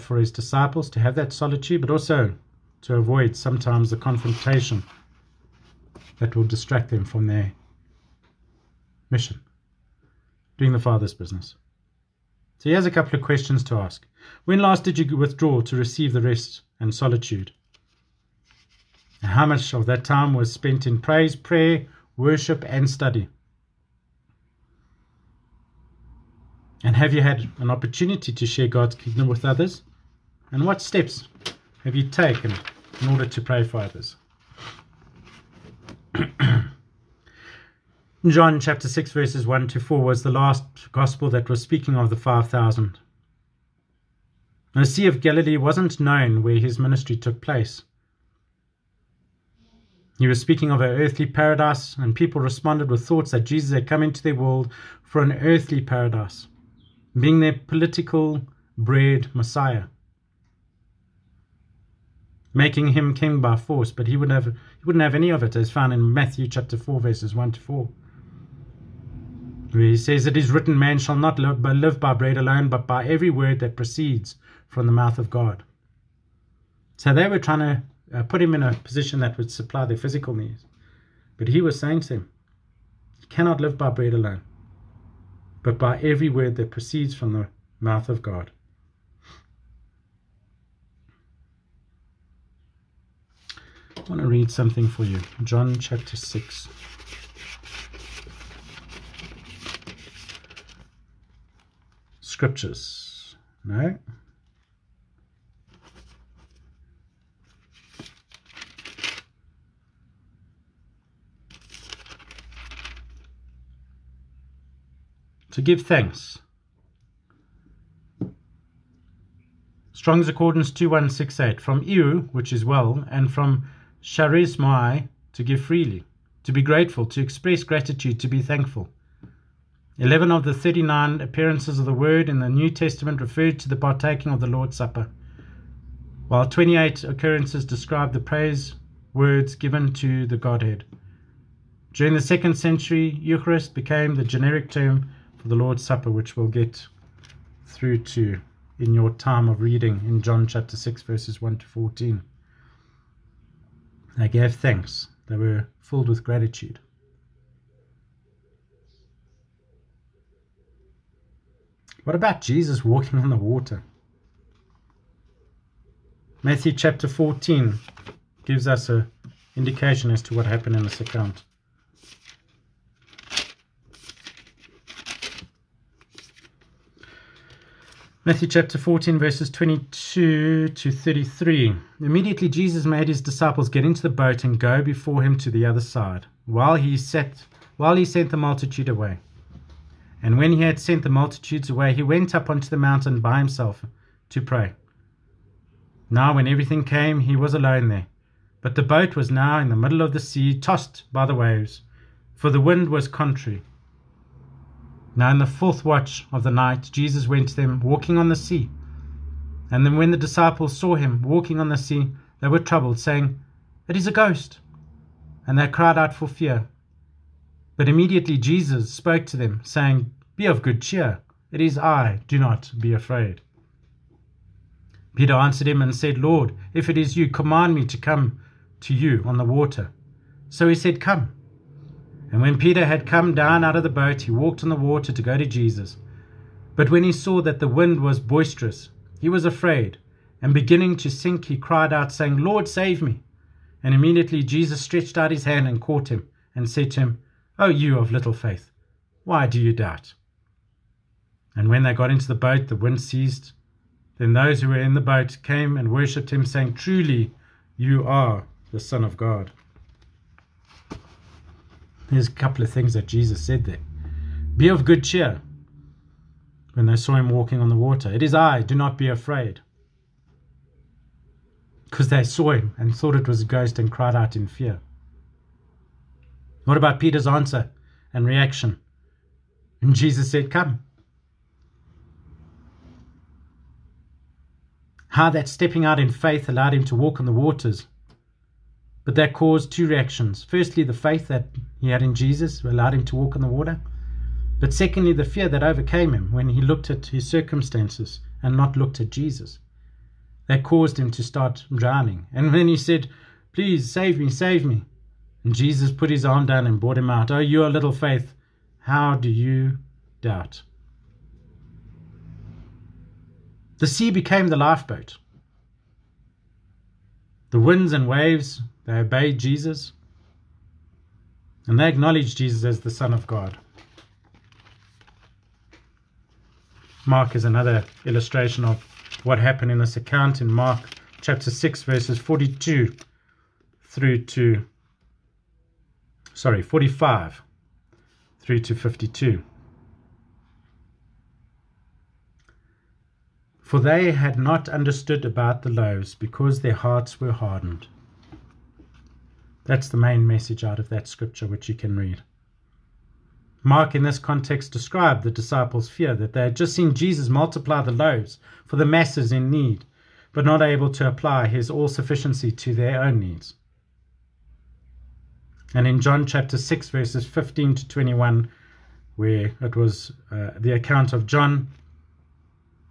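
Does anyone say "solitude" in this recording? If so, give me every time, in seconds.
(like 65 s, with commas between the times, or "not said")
1 s, 16 s.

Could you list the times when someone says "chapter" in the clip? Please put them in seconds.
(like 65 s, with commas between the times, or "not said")
38 s, 66 s, 95 s, 150 s, 166 s, 178 s, 331 s, 366 s.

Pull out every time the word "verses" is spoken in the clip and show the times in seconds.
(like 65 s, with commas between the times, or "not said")
39 s, 66 s, 151 s, 179 s, 331 s, 366 s.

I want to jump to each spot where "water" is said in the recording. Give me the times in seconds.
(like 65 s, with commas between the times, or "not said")
163 s, 229 s, 234 s, 267 s, 287 s, 293 s.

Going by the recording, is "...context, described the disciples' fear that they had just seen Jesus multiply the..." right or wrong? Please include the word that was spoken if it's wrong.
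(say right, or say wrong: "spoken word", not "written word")
right.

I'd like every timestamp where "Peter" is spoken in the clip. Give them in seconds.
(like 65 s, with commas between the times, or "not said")
225 s, 232 s, 276 s.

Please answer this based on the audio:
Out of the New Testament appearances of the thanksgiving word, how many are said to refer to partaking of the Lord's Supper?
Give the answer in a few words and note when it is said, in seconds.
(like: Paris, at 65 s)
11, at 129 s.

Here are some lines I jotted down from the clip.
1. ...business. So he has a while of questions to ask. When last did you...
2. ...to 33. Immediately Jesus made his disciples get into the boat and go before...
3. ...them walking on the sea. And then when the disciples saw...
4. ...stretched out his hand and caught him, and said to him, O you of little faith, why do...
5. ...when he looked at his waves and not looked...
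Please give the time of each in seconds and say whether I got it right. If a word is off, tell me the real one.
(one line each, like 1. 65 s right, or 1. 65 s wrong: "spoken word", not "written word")
1. 11 s wrong: "couple", not "while"
2. 180 s right
3. 207 s right
4. 244 s right
5. 296 s wrong: "circumstances", not "waves".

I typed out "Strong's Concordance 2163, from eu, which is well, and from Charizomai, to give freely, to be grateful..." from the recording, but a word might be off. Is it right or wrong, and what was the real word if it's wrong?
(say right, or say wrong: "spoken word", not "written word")
wrong: "2168", not "2163".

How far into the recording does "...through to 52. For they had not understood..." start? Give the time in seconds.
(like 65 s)
338 s.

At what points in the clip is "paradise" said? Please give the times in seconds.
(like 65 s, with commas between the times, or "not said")
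51 s, 55 s.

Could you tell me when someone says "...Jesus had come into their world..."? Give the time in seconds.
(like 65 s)
53 s.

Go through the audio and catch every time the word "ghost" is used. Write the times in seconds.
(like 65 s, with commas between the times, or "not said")
214 s, 273 s.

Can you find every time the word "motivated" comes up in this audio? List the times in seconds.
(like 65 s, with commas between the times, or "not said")
not said.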